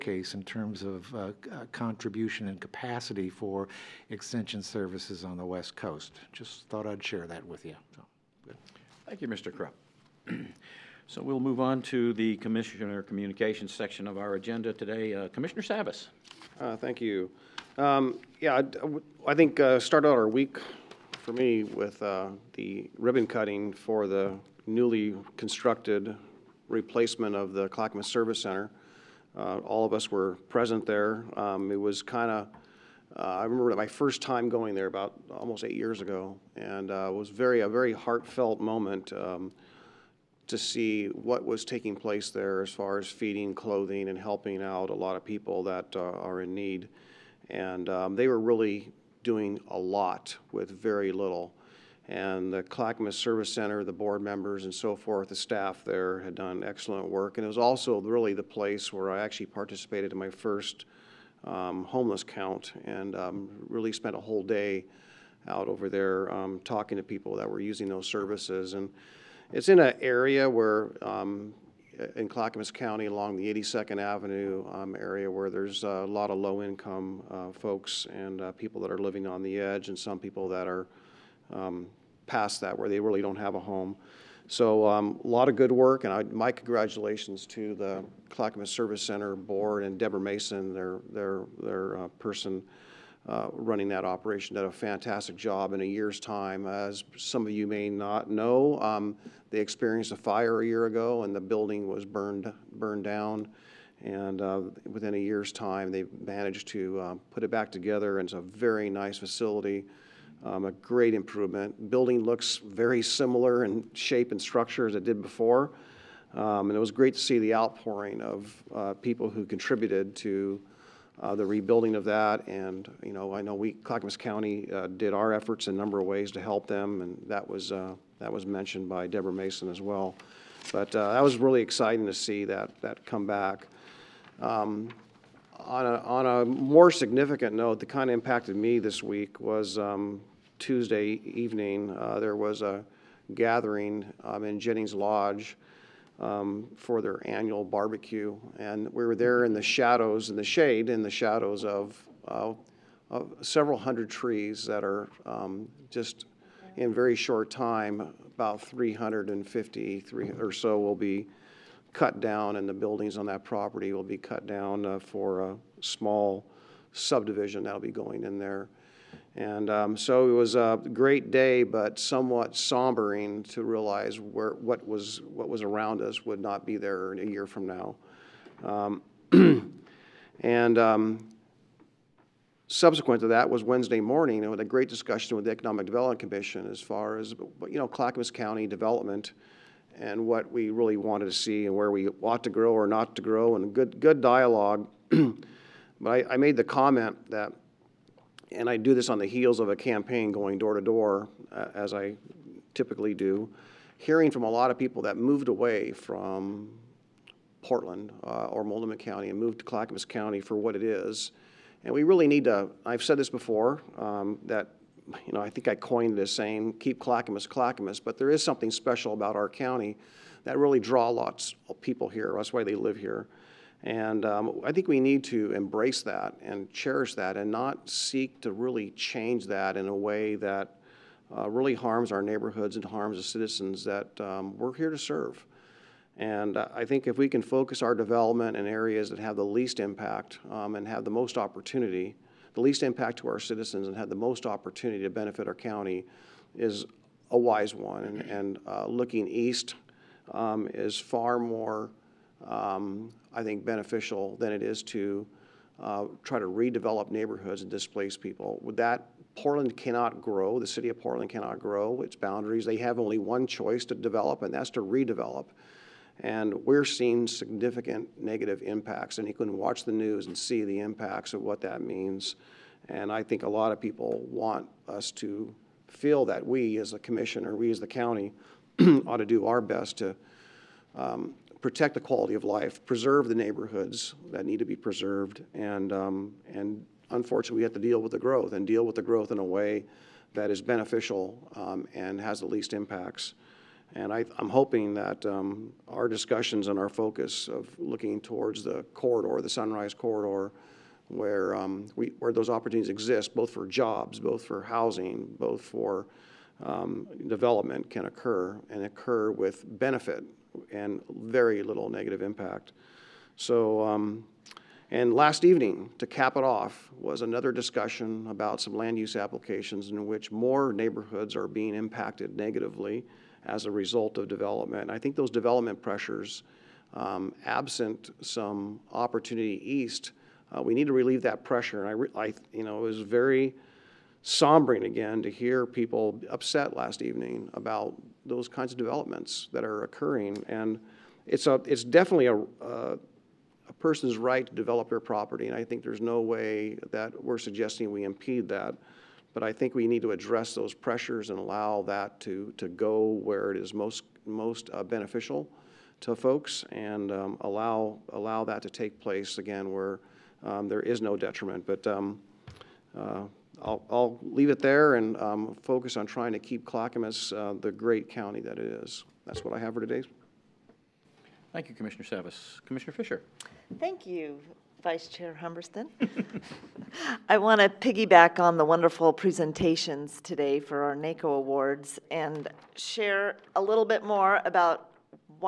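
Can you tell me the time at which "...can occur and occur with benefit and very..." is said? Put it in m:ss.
5:07.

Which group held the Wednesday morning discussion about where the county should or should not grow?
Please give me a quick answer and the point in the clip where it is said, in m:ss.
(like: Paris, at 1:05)
Economic Development Commission, at 3:05.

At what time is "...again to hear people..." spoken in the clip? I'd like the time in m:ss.
5:34.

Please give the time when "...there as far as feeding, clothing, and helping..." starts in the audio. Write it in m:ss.
0:42.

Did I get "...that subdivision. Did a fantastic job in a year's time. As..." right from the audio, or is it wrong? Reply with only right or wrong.
wrong.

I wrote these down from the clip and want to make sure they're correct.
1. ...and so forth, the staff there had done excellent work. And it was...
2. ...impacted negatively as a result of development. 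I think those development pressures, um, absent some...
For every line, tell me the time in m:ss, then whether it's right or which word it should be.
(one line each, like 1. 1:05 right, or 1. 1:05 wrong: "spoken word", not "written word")
1. 0:54 right
2. 5:21 right.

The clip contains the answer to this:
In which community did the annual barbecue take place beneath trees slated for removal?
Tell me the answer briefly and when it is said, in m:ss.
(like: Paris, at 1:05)
Jennings Lodge, at 2:24.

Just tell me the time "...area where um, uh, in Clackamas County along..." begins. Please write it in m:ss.
1:10.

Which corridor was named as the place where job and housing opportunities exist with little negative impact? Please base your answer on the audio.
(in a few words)
Sunrise Corridor.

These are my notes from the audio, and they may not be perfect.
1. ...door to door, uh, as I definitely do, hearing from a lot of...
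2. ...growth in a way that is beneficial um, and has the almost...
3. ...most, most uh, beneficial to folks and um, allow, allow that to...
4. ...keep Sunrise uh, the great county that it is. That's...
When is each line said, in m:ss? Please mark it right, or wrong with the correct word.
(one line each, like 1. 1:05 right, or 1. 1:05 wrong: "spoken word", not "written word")
1. 3:20 wrong: "typically", not "definitely"
2. 4:49 wrong: "least", not "almost"
3. 5:53 right
4. 6:06 wrong: "Clackamas", not "Sunrise".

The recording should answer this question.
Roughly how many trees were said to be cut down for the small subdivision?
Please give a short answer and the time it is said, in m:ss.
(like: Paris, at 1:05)
350, at 2:38.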